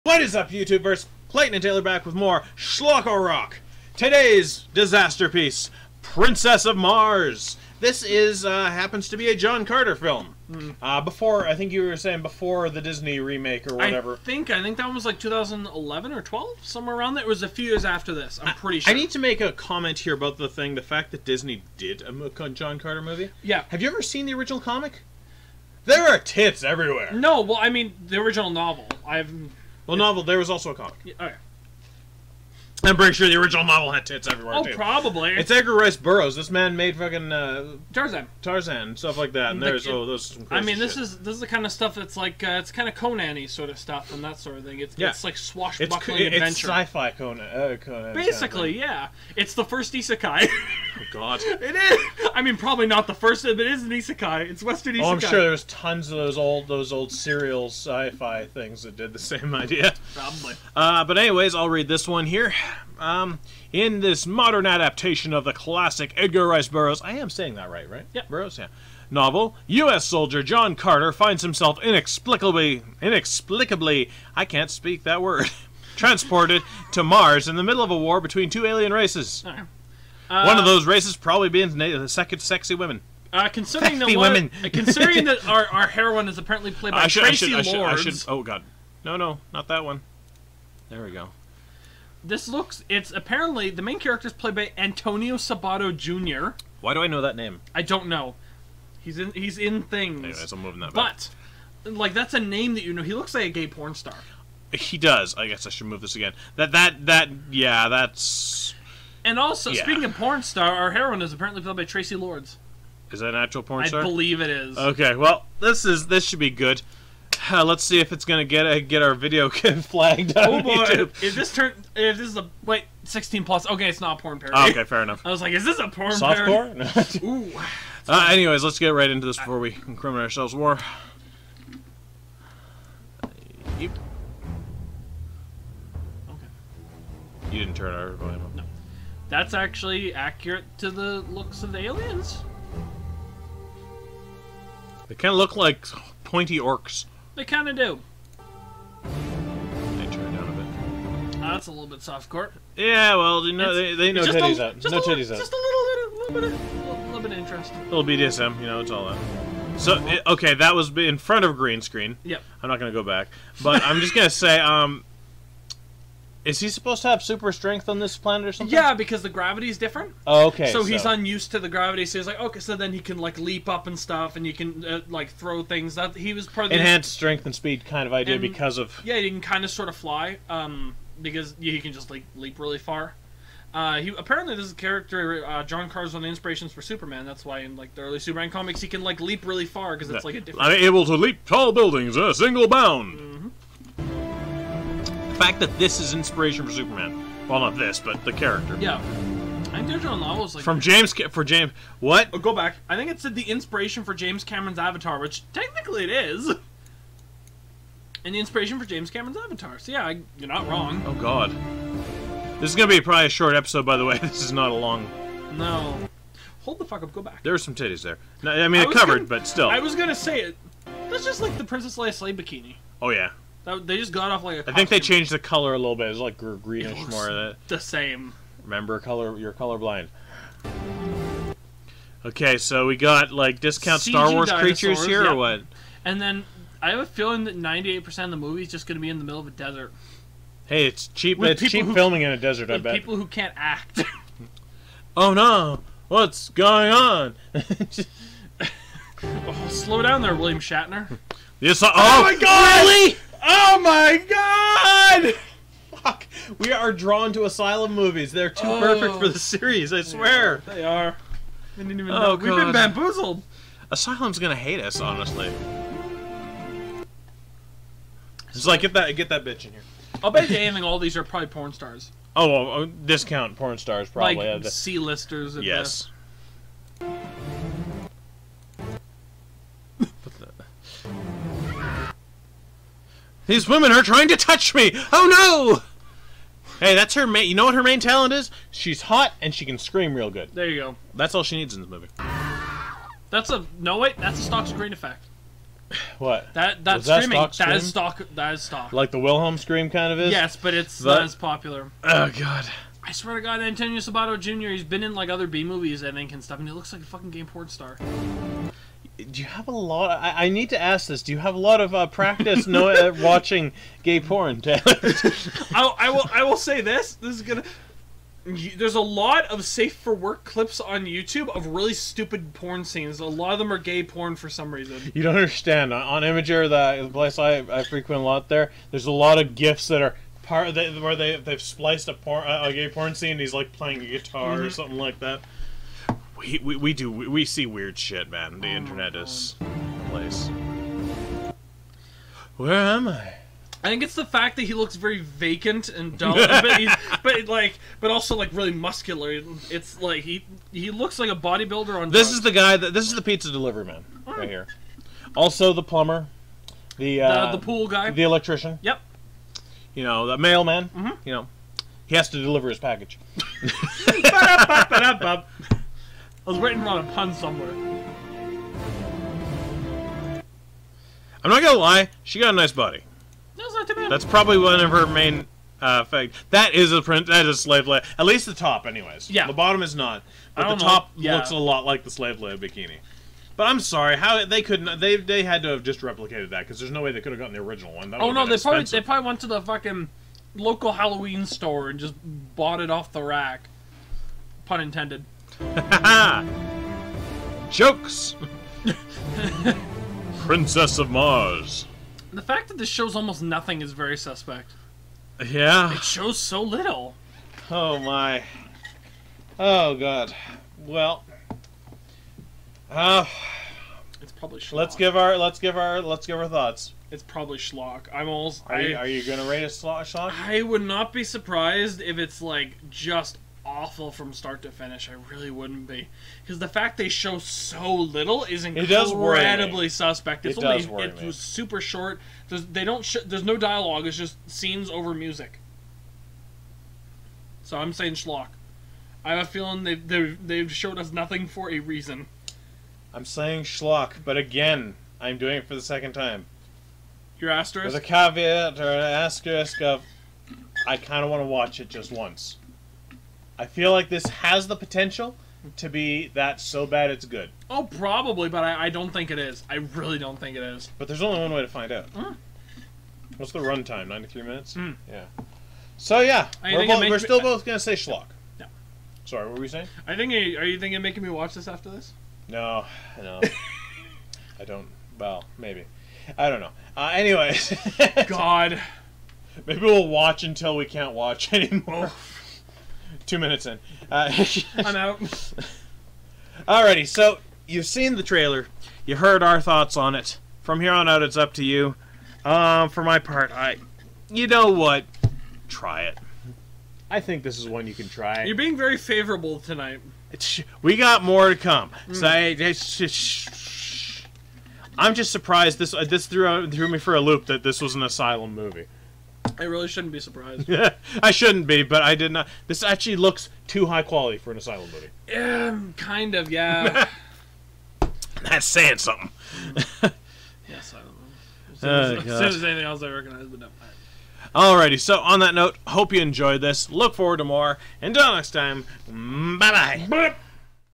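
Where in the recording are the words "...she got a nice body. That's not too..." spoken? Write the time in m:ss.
6:12.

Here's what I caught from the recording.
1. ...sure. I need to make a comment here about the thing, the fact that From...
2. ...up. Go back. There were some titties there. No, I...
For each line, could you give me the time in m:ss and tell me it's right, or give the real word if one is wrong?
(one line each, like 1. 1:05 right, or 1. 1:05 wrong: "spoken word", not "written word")
1. 0:18 wrong: "Disney", not "From"
2. 3:37 right.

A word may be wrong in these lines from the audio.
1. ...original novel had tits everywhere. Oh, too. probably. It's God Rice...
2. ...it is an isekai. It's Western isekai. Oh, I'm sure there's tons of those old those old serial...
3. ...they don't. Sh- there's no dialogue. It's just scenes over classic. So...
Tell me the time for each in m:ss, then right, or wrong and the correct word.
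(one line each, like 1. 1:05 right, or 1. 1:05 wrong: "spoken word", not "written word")
1. 0:33 wrong: "Edgar", not "God"
2. 0:53 right
3. 7:12 wrong: "music", not "classic".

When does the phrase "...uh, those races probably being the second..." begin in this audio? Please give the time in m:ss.
1:20.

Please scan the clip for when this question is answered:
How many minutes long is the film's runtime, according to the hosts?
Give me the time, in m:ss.
7:44.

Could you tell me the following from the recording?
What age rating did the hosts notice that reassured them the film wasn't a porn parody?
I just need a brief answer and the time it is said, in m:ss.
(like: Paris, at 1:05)
Sixteen plus, at 2:03.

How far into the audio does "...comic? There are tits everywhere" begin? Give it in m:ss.
0:24.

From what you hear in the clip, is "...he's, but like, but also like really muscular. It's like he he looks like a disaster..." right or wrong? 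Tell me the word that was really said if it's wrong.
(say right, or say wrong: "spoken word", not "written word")
wrong: "bodybuilder", not "disaster".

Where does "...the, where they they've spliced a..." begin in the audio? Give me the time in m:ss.
5:30.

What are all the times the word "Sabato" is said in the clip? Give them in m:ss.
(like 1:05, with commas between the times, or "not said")
1:35, 5:03.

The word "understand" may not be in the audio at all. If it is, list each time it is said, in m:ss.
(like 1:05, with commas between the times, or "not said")
5:25.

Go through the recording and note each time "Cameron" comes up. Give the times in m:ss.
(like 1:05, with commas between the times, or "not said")
3:24, 3:29.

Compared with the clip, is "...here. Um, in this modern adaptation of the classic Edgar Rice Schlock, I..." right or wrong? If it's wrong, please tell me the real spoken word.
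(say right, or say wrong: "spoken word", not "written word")
wrong: "Burroughs", not "Schlock".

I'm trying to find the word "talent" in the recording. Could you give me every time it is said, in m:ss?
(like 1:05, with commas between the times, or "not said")
4:47.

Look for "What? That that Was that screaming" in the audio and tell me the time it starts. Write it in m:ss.
4:56.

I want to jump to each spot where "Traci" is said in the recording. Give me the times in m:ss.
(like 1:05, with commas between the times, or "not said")
1:27, 1:51.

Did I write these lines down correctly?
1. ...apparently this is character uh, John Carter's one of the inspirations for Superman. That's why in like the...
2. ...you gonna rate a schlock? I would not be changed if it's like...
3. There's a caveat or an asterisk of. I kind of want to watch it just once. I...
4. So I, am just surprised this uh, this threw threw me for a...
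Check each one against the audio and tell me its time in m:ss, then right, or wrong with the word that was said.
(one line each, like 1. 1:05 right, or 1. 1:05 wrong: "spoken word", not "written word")
1. 3:04 right
2. 6:59 wrong: "surprised", not "changed"
3. 7:27 right
4. 8:22 right.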